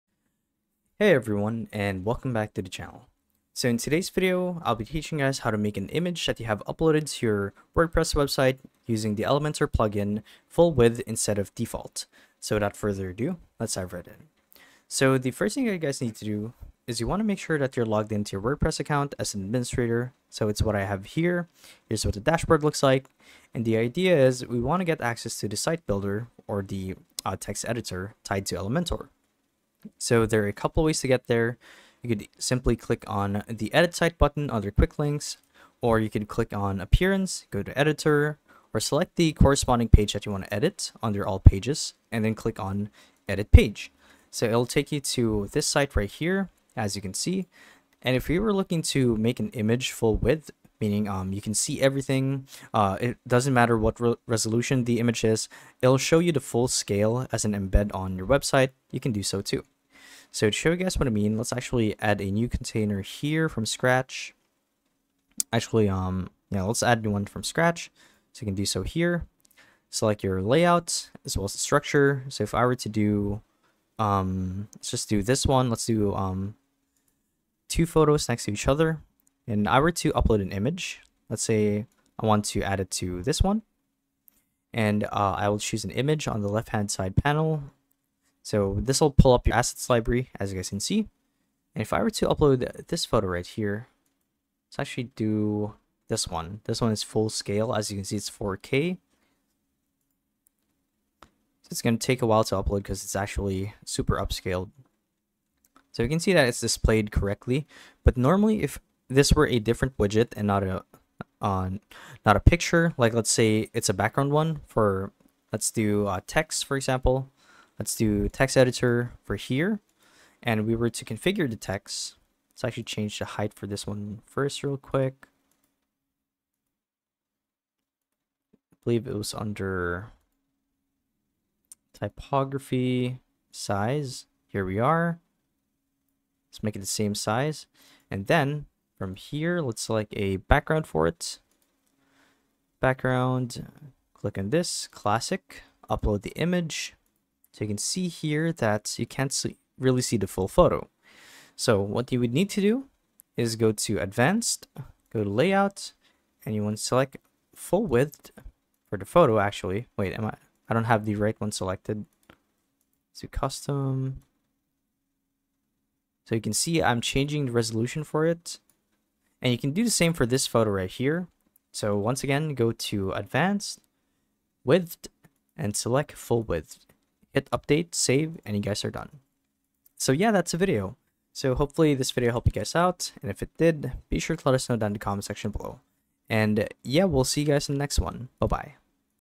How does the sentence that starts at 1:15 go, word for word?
Let's do um, two photos next to each other.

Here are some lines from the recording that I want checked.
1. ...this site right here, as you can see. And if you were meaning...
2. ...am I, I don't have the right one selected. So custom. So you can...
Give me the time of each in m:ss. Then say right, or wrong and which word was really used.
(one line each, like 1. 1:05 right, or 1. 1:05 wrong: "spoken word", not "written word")
1. 0:45 wrong: "looking", not "meaning"
2. 2:40 right.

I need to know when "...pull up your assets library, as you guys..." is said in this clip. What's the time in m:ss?
1:29.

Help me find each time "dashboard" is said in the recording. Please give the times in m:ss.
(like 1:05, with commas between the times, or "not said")
0:22.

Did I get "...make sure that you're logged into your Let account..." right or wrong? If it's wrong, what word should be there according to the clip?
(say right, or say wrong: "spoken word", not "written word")
wrong: "WordPress", not "Let".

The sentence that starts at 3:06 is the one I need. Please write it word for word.
And yeah, we'll see you guys in the next one.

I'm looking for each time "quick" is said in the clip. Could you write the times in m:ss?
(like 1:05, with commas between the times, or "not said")
0:34, 2:04.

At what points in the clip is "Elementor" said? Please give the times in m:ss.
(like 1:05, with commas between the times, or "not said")
0:09, 0:28.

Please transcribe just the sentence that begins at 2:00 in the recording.
And we were to configure the text.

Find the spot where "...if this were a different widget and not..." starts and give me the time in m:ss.
1:48.